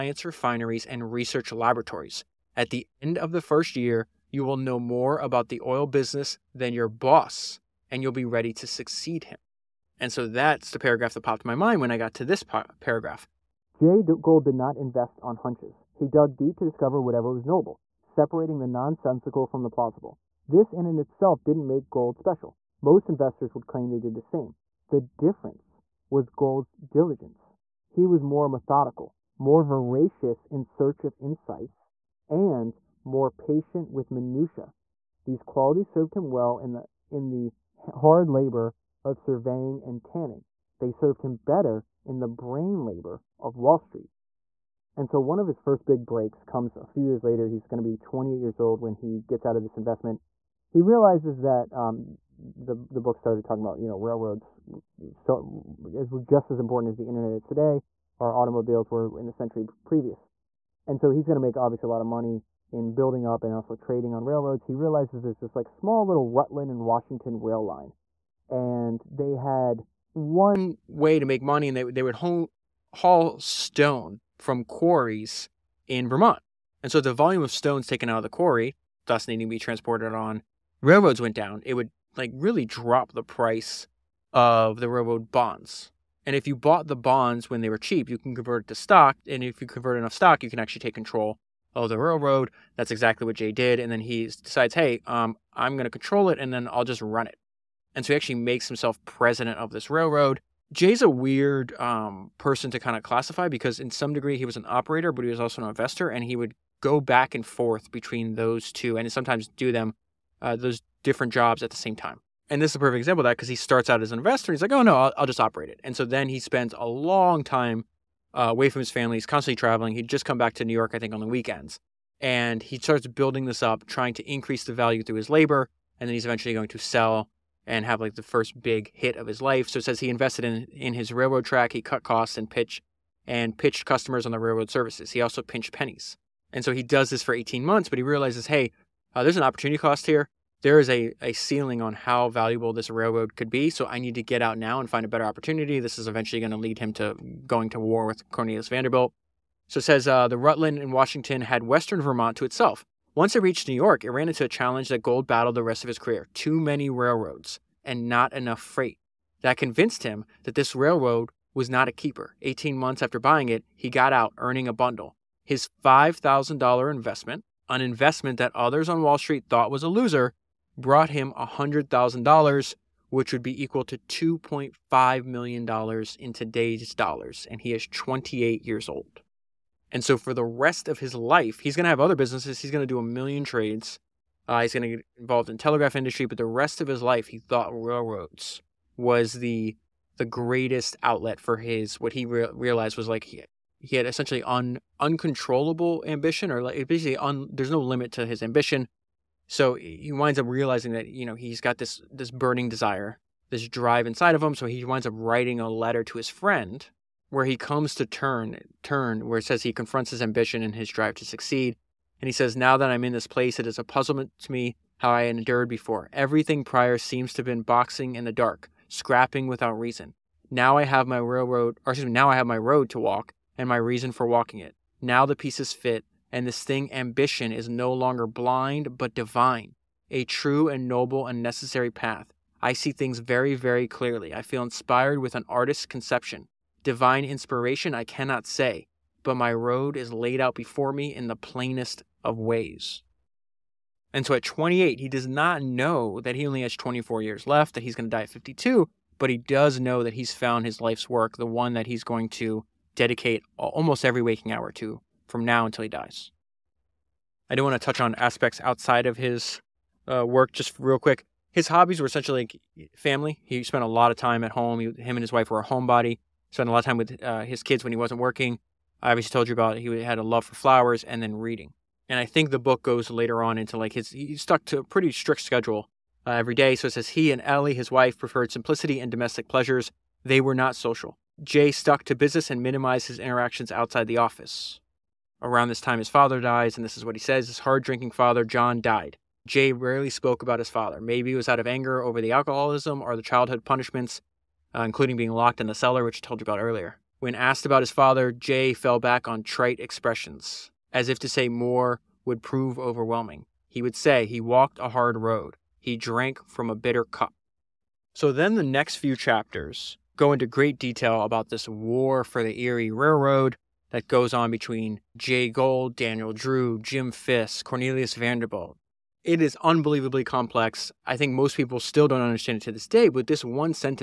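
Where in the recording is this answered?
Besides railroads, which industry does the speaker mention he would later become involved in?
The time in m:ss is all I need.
3:05.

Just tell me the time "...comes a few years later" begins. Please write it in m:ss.
0:46.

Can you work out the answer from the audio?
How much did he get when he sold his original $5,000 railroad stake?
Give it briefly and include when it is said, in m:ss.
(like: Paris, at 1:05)
$100,000, at 2:51.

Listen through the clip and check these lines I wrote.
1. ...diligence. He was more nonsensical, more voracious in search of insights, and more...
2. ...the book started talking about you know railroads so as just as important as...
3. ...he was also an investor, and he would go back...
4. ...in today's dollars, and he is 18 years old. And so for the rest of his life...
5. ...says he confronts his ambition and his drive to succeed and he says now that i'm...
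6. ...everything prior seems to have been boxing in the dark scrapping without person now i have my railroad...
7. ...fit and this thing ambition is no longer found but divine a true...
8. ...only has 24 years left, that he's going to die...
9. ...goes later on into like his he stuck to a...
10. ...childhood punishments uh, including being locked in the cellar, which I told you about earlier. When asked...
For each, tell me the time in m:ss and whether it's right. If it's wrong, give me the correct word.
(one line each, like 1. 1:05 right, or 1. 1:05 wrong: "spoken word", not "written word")
1. 0:26 wrong: "methodical", not "nonsensical"
2. 0:52 right
3. 1:45 right
4. 2:56 wrong: "28", not "18"
5. 3:29 right
6. 3:36 wrong: "reason", not "person"
7. 3:45 wrong: "blind", not "found"
8. 4:06 right
9. 4:32 right
10. 4:53 right.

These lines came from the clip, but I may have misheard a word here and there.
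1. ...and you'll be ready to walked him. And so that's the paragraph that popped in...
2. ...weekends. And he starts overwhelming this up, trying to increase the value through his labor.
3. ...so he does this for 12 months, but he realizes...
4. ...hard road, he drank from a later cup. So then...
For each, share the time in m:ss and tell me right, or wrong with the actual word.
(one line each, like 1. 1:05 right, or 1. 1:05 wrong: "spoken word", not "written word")
1. 0:07 wrong: "succeed", not "walked"
2. 2:01 wrong: "building", not "overwhelming"
3. 2:16 wrong: "18", not "12"
4. 5:04 wrong: "bitter", not "later".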